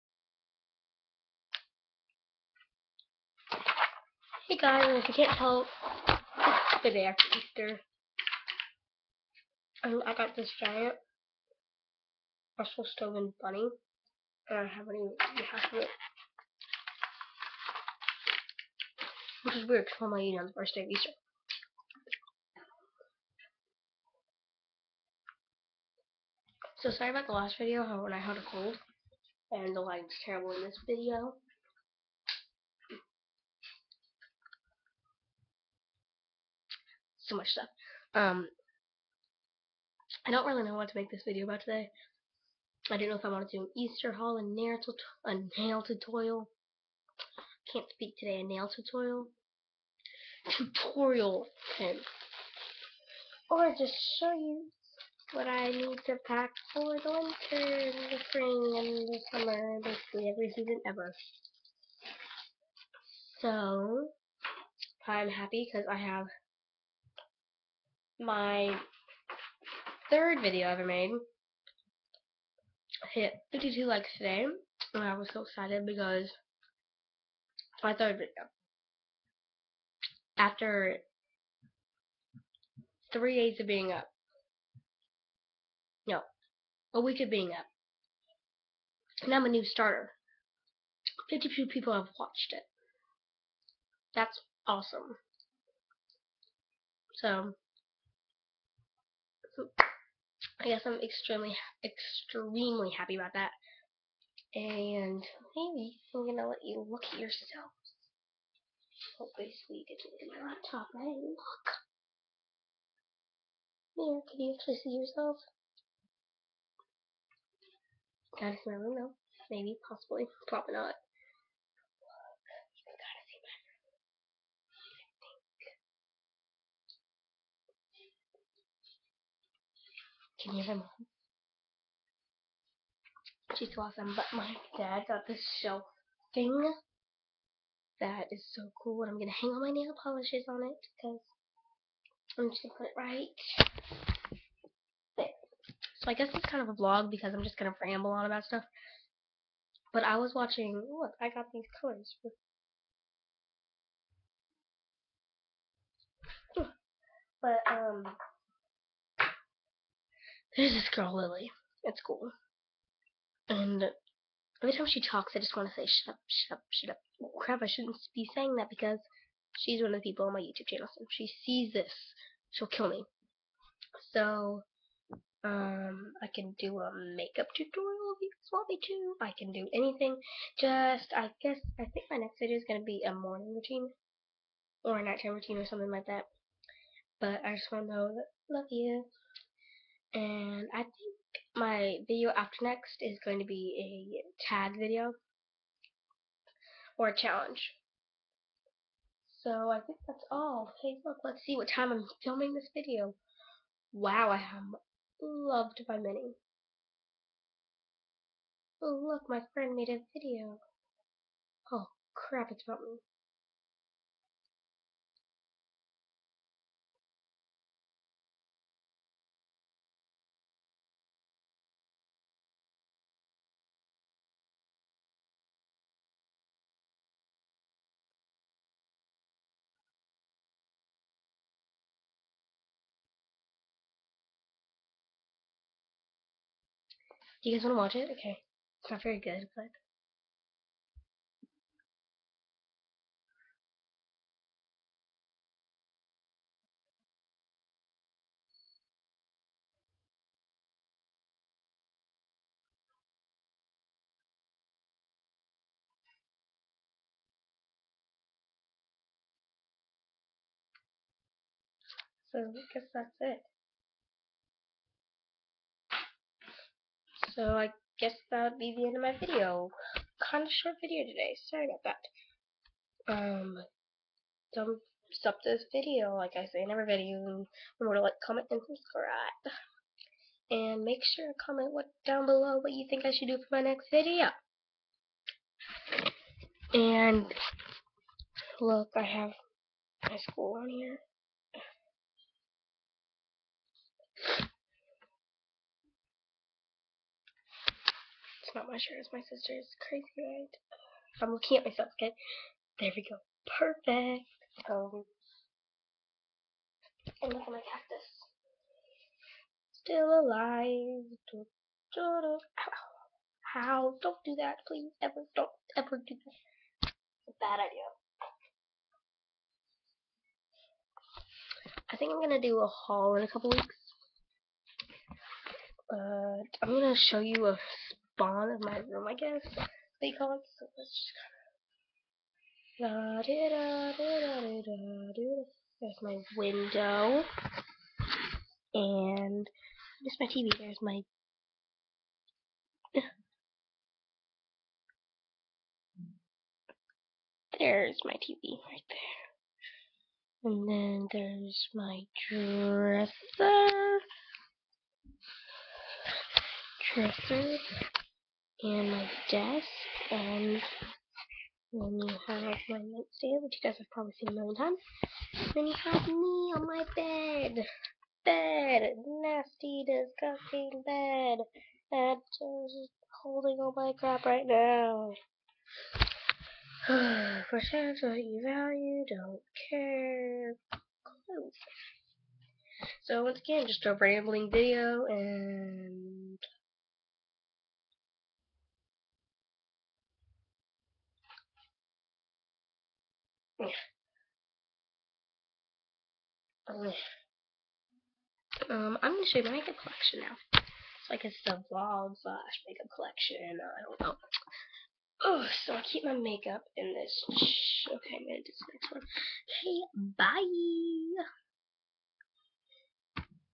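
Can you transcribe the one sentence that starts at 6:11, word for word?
just holding all my crap right now.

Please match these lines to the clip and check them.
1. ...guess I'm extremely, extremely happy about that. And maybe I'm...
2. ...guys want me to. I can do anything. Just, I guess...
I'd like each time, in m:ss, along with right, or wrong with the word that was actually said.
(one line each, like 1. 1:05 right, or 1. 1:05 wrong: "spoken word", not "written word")
1. 1:40 right
2. 2:58 right.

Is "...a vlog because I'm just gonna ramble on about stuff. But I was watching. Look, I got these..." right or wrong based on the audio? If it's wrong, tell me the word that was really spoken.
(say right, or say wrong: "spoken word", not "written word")
right.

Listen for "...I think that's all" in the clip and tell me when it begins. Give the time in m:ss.
3:19.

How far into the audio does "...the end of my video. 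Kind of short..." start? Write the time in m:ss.
4:28.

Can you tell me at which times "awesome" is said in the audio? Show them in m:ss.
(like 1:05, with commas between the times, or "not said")
1:34, 2:13.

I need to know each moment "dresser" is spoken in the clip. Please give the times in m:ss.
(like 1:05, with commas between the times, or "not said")
5:52, 5:56.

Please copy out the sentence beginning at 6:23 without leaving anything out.
So once again, just a rambling video, and...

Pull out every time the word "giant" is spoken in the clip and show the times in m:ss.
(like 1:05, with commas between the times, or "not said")
0:10.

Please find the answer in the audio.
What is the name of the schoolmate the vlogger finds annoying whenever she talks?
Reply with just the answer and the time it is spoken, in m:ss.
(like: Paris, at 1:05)
Lily, at 2:41.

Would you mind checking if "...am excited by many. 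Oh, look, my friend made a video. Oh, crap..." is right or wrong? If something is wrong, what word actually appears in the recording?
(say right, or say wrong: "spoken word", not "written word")
wrong: "loved", not "excited".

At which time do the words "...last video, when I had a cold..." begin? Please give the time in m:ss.
0:27.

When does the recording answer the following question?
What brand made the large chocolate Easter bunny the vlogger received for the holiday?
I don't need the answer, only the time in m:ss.
0:12.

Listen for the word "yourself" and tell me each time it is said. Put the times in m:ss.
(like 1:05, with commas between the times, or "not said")
1:47, 1:54.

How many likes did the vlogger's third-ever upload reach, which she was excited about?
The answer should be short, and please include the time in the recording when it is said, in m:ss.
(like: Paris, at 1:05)
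52, at 1:13.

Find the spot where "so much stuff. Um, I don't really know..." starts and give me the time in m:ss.
0:37.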